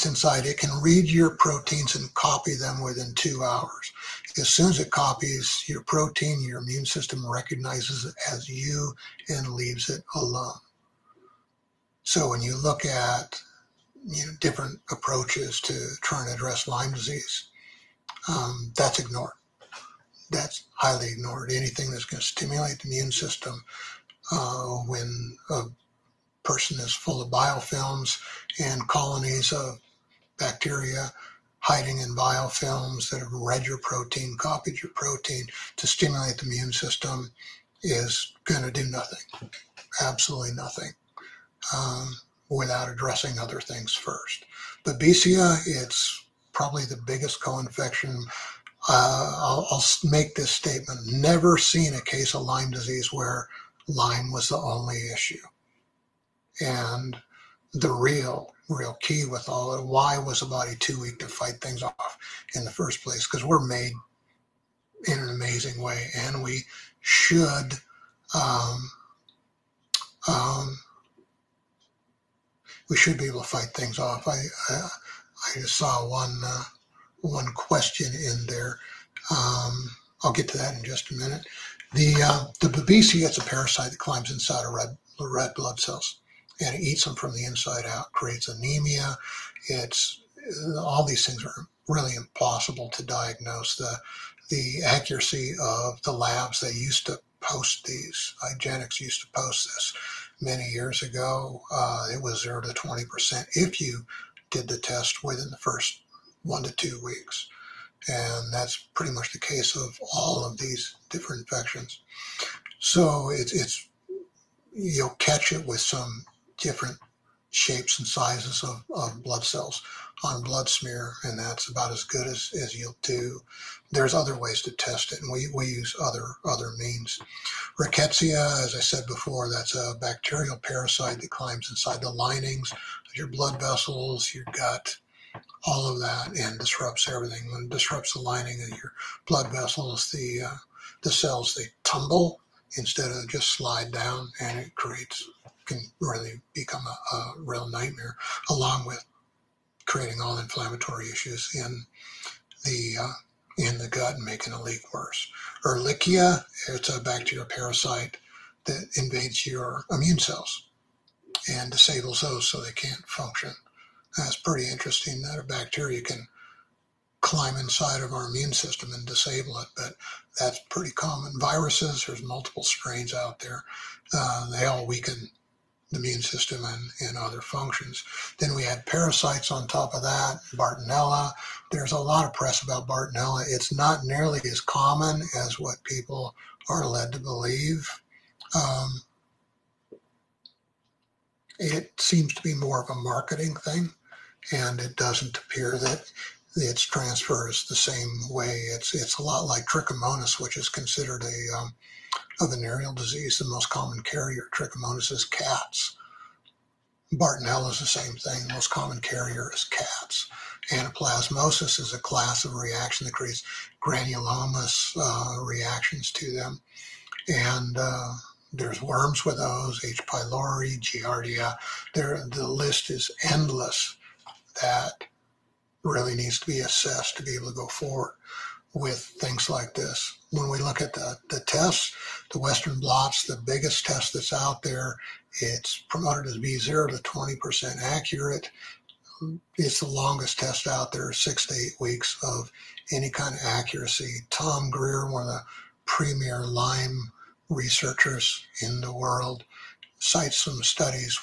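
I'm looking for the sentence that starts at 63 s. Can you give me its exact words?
Because we're made in an amazing way, and we should um, um, we should be able to fight things off.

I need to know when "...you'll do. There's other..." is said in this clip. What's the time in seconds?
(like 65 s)
122 s.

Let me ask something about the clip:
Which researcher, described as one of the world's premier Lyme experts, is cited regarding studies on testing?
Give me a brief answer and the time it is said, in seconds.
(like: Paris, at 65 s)
Tom Grier, at 244 s.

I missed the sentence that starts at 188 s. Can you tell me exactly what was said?
Um, it seems to be more of a marketing thing, and it doesn't appear that its transfer is the same way.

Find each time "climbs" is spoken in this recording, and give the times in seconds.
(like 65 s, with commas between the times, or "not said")
83 s, 131 s, 167 s.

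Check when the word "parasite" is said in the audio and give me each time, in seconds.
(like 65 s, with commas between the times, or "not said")
83 s, 130 s, 157 s, 178 s.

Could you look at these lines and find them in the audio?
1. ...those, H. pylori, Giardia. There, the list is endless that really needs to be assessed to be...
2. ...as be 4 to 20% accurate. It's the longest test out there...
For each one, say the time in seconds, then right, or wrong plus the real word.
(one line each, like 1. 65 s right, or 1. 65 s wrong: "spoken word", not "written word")
1. 219 s right
2. 236 s wrong: "0", not "4".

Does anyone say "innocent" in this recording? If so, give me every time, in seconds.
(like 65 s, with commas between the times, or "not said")
not said.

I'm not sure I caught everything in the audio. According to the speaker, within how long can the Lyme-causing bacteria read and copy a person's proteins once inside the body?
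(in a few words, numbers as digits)
2 hours.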